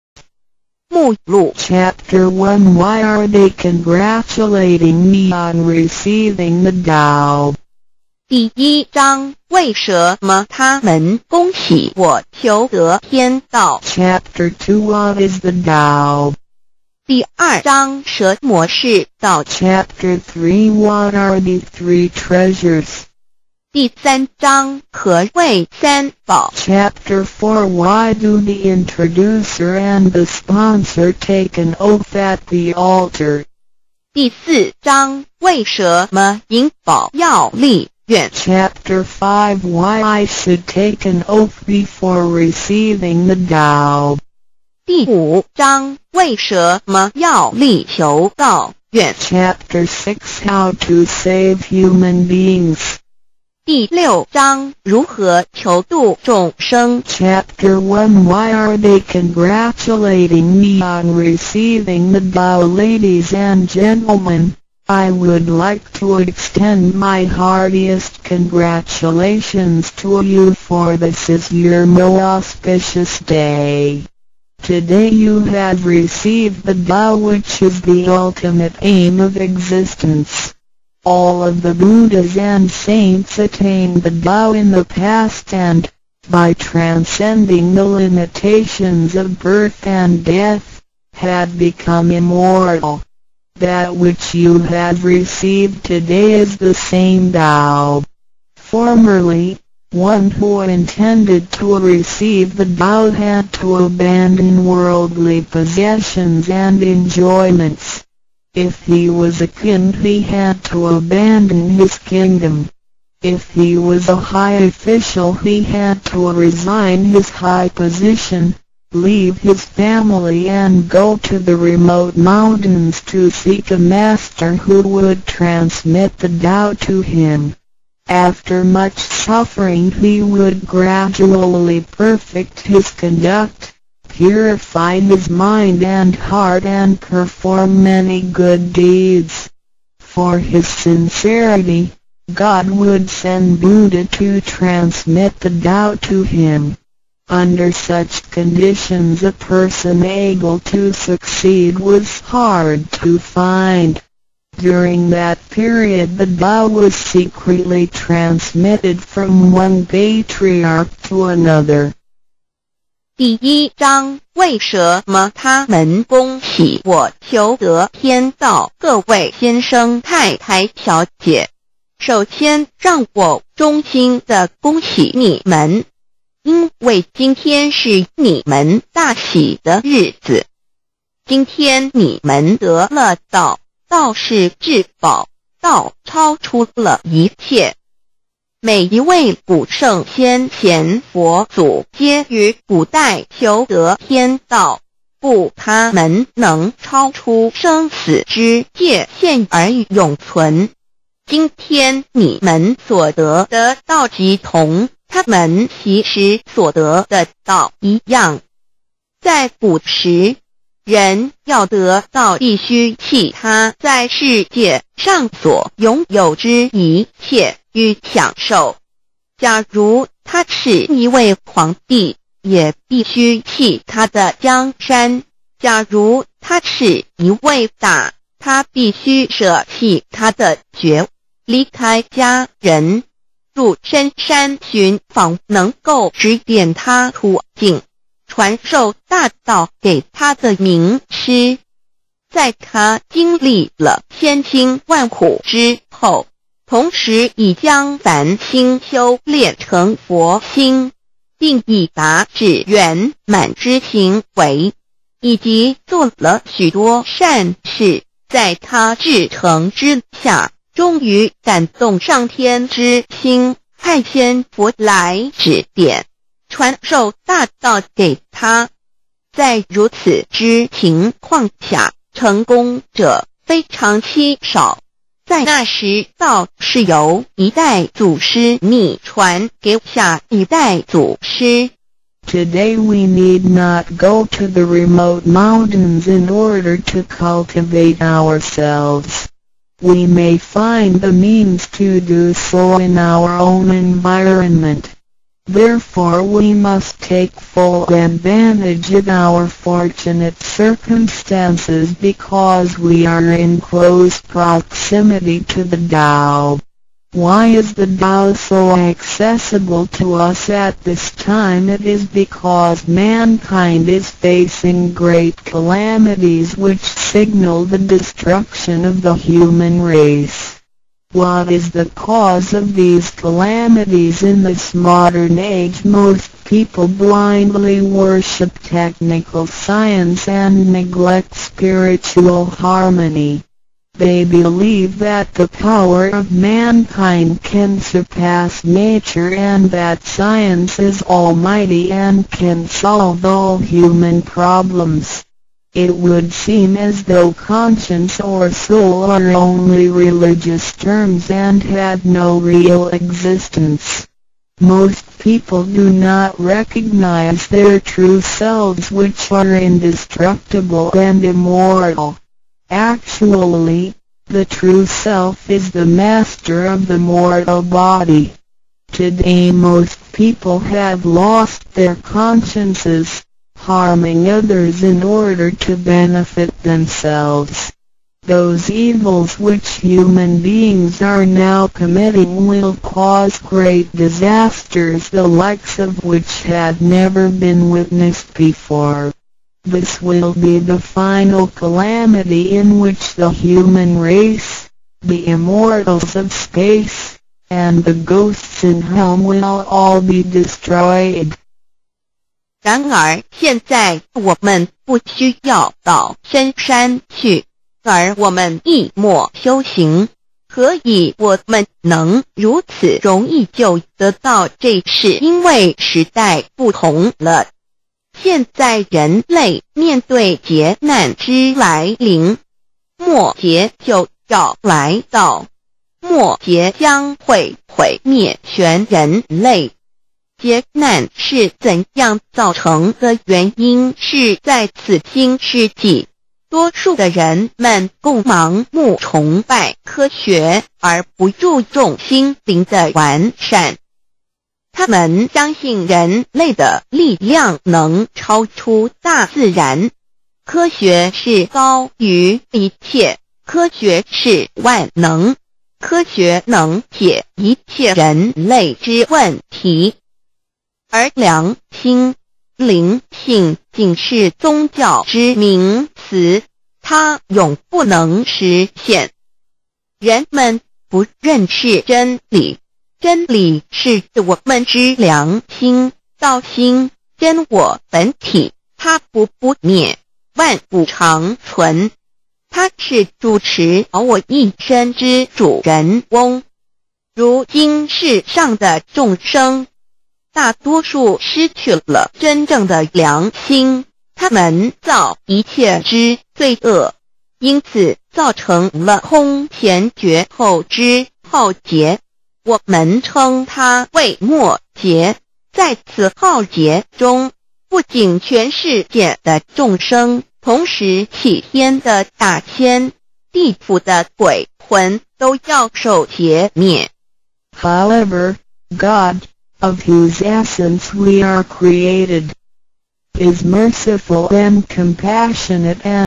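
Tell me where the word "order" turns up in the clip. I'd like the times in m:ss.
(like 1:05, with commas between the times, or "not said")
4:46, 6:15.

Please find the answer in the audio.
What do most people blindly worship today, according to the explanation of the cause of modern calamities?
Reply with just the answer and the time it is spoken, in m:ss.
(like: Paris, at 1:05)
technical science, at 5:28.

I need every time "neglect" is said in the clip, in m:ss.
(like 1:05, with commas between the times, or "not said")
5:30.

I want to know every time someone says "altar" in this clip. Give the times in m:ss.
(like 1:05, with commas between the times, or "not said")
0:32.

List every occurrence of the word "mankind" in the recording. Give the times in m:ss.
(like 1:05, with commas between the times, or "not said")
5:12, 5:36.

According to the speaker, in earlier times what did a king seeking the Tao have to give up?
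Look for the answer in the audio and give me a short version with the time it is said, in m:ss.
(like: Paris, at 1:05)
his kingdom, at 1:51.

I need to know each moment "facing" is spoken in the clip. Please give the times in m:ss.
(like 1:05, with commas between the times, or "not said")
5:14.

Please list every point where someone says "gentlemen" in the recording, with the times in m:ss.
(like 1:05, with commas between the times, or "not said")
1:03.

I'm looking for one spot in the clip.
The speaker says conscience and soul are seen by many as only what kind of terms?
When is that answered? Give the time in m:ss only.
5:49.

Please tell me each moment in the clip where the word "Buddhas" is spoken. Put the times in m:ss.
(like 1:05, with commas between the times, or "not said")
1:21, 2:23.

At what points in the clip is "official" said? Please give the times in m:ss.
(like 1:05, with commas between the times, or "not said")
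1:54.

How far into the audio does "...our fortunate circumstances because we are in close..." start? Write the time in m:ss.
4:59.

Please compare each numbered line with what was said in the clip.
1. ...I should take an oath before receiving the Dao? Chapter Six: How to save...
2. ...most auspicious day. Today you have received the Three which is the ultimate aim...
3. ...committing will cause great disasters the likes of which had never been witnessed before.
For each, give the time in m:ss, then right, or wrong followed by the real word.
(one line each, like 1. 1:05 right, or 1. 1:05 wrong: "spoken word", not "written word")
1. 0:40 right
2. 1:11 wrong: "Tao", not "Three"
3. 6:21 right.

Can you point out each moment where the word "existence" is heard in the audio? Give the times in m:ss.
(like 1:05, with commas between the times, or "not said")
1:19, 5:52.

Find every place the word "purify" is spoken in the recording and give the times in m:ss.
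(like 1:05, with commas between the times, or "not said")
2:14.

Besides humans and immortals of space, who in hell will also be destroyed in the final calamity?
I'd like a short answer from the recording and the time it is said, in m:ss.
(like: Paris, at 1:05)
the ghosts, at 6:37.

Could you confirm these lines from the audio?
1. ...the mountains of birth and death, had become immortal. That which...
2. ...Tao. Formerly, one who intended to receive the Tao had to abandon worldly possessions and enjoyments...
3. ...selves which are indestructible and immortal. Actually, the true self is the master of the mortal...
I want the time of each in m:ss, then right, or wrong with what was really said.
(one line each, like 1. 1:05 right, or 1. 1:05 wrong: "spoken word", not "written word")
1. 1:27 wrong: "limitations", not "mountains"
2. 1:37 right
3. 5:58 right.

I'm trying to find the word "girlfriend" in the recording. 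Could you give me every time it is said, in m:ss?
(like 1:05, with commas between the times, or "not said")
not said.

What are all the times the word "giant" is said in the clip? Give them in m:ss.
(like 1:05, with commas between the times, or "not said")
not said.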